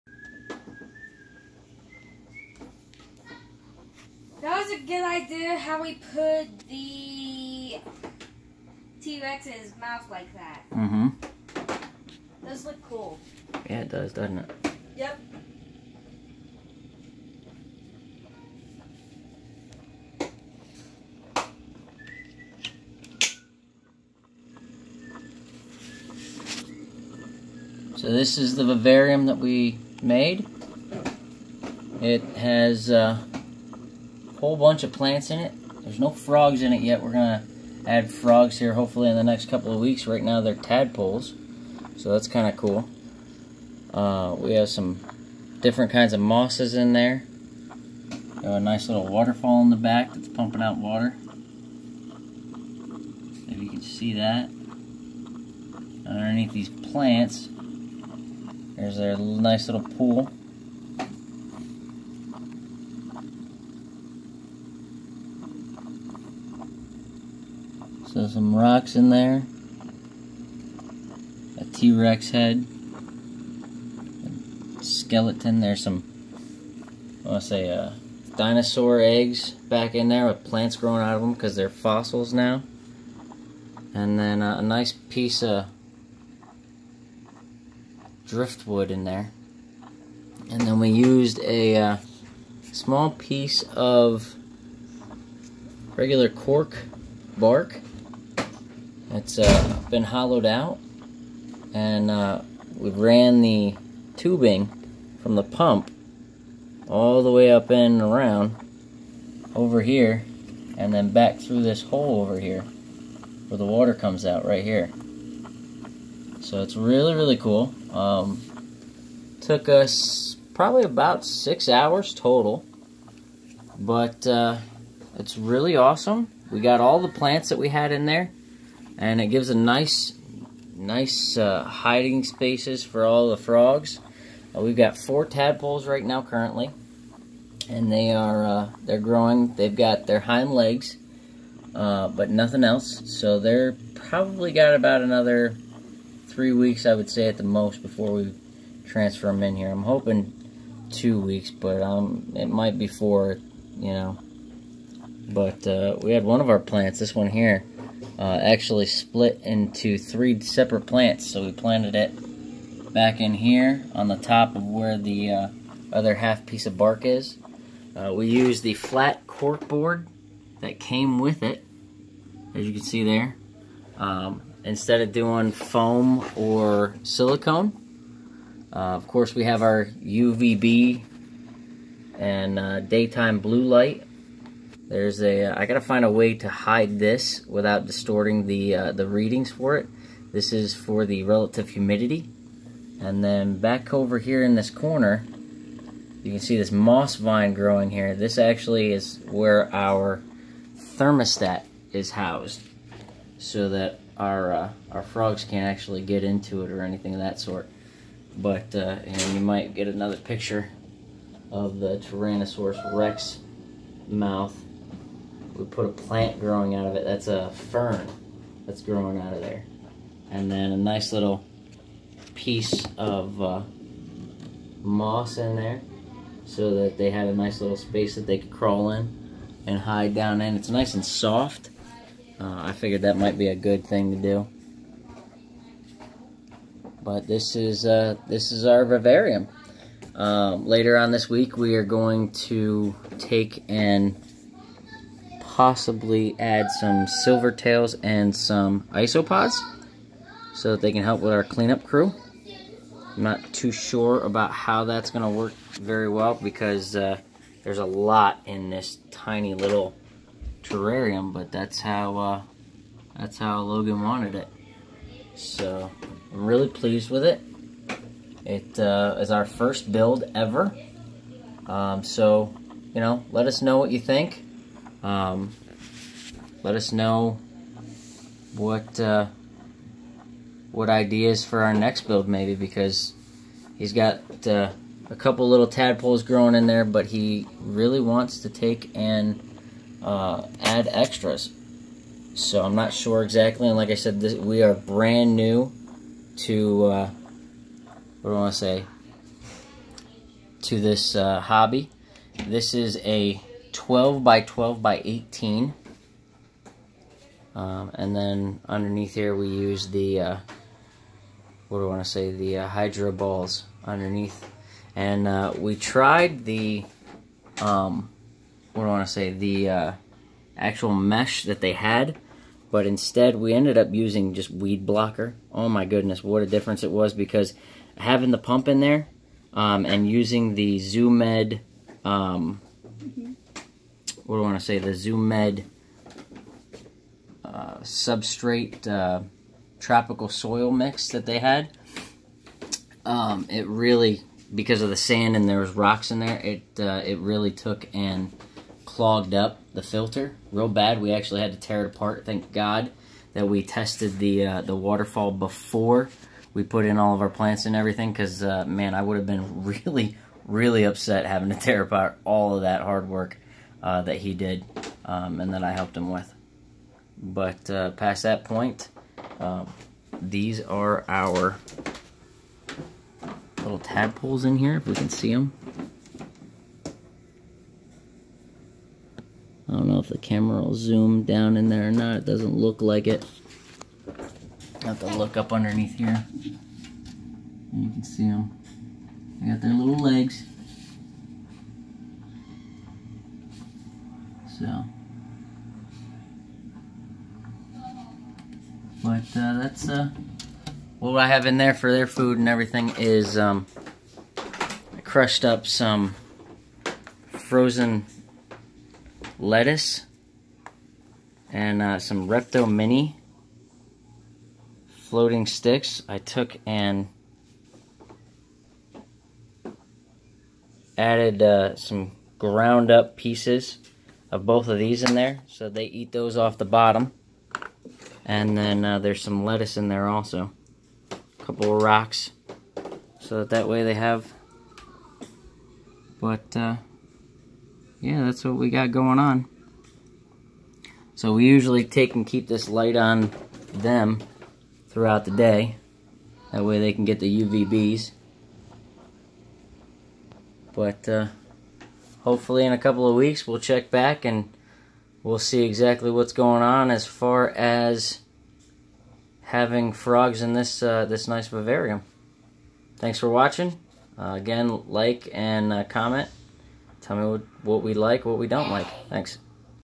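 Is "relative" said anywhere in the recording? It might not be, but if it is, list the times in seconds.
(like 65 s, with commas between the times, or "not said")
191 s.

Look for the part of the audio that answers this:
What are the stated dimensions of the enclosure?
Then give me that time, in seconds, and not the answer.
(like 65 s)
303 s.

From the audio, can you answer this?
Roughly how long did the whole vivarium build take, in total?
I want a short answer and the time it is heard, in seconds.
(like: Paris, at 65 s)
6 hours, at 120 s.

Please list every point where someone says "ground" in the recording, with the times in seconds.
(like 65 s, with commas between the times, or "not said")
422 s.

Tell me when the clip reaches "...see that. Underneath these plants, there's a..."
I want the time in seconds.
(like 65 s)
53 s.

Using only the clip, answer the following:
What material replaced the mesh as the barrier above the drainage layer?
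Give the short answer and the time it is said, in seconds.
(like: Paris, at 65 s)
weed blocker, at 324 s.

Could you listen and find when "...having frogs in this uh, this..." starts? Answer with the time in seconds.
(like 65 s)
459 s.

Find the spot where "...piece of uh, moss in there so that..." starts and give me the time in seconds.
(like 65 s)
222 s.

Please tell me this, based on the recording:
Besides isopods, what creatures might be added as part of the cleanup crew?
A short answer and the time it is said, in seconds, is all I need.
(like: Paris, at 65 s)
silver tails, at 247 s.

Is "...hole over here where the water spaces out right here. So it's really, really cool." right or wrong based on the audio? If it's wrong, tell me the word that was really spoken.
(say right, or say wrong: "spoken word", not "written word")
wrong: "comes", not "spaces".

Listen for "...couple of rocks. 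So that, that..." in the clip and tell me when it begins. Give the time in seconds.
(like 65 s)
431 s.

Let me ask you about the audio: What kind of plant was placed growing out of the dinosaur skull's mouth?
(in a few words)
fern.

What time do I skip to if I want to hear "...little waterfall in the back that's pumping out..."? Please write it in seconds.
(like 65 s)
48 s.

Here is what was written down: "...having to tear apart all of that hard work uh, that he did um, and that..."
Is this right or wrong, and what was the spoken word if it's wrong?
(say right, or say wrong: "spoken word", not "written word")
right.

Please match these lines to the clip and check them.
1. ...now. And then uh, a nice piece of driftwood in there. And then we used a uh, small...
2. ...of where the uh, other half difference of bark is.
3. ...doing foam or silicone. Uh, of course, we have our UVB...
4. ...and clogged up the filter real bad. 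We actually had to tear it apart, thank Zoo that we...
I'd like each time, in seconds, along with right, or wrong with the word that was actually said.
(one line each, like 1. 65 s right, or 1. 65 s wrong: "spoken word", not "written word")
1. 82 s right
2. 164 s wrong: "piece", not "difference"
3. 175 s right
4. 347 s wrong: "God", not "Zoo".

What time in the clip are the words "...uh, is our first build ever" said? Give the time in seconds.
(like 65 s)
268 s.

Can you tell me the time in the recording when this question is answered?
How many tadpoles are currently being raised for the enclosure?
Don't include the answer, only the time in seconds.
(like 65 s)
134 s.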